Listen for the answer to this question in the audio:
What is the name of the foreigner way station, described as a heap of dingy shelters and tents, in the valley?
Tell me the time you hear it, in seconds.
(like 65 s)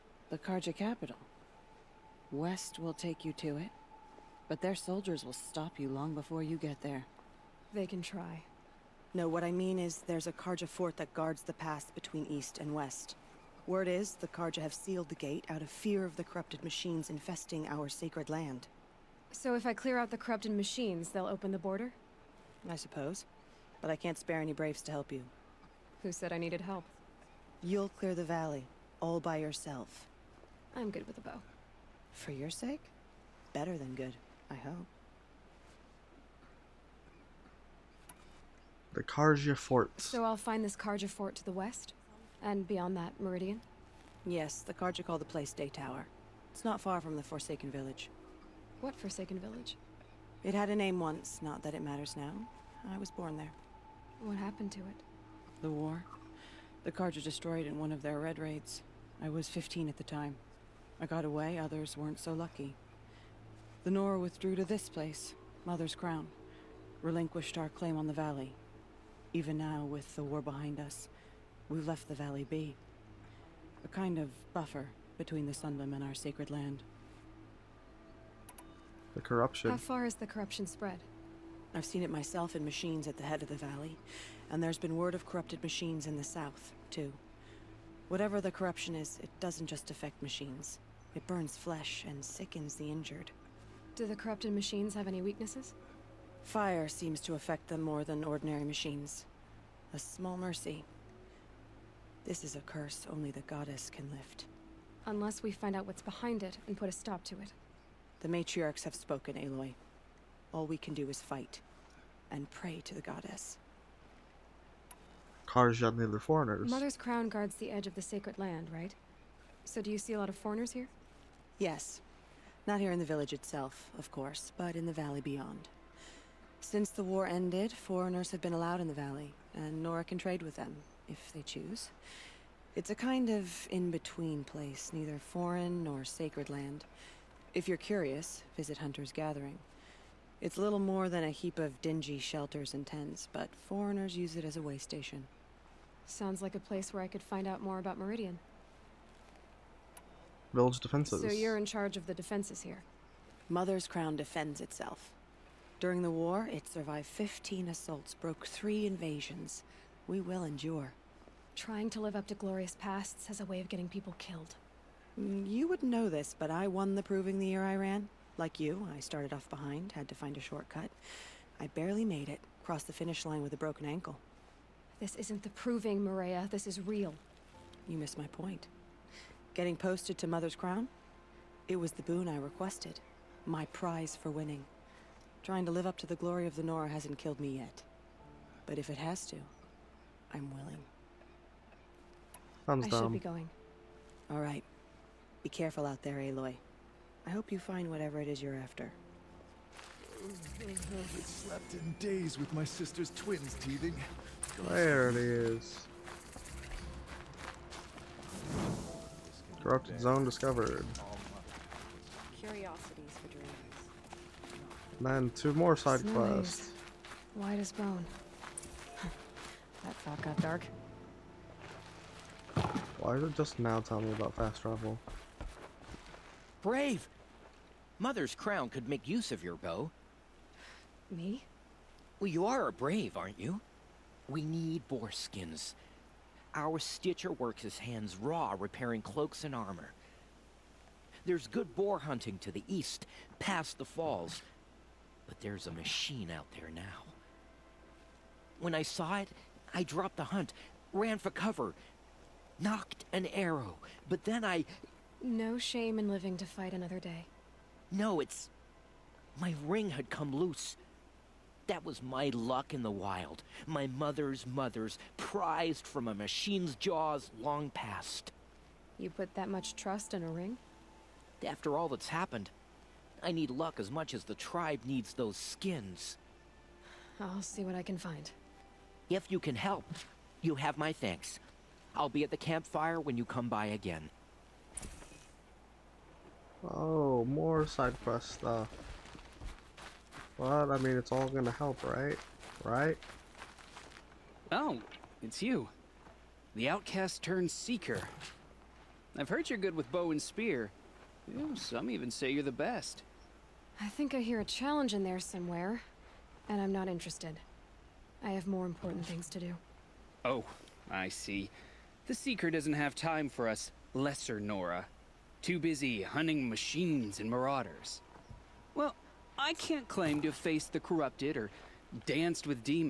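138 s.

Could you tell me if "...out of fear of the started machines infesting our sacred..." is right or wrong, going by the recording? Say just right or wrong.
wrong.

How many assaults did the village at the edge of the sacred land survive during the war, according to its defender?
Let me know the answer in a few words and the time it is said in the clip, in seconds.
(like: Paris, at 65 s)
15, at 157 s.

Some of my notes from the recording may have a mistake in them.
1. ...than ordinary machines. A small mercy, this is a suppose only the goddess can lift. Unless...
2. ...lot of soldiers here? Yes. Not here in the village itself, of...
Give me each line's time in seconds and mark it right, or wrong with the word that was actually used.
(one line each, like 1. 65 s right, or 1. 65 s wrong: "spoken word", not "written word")
1. 98 s wrong: "curse", not "suppose"
2. 120 s wrong: "foreigners", not "soldiers".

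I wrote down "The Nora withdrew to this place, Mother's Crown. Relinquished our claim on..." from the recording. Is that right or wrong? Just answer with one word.
right.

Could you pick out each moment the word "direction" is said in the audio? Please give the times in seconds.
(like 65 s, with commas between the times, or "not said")
not said.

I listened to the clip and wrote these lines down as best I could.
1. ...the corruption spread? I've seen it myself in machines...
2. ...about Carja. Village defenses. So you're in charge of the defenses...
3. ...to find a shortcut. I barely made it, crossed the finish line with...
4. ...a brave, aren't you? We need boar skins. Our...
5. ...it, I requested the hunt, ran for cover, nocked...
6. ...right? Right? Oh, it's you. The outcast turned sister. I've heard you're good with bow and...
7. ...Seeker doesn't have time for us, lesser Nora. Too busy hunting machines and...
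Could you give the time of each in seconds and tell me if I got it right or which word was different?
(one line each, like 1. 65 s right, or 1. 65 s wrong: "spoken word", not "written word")
1. 80 s right
2. 147 s wrong: "Meridian", not "Carja"
3. 170 s right
4. 232 s right
5. 249 s wrong: "dropped", not "requested"
6. 291 s wrong: "seeker", not "sister"
7. 312 s right.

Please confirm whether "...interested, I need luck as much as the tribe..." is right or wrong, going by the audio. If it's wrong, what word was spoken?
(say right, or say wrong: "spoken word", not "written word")
wrong: "happened", not "interested".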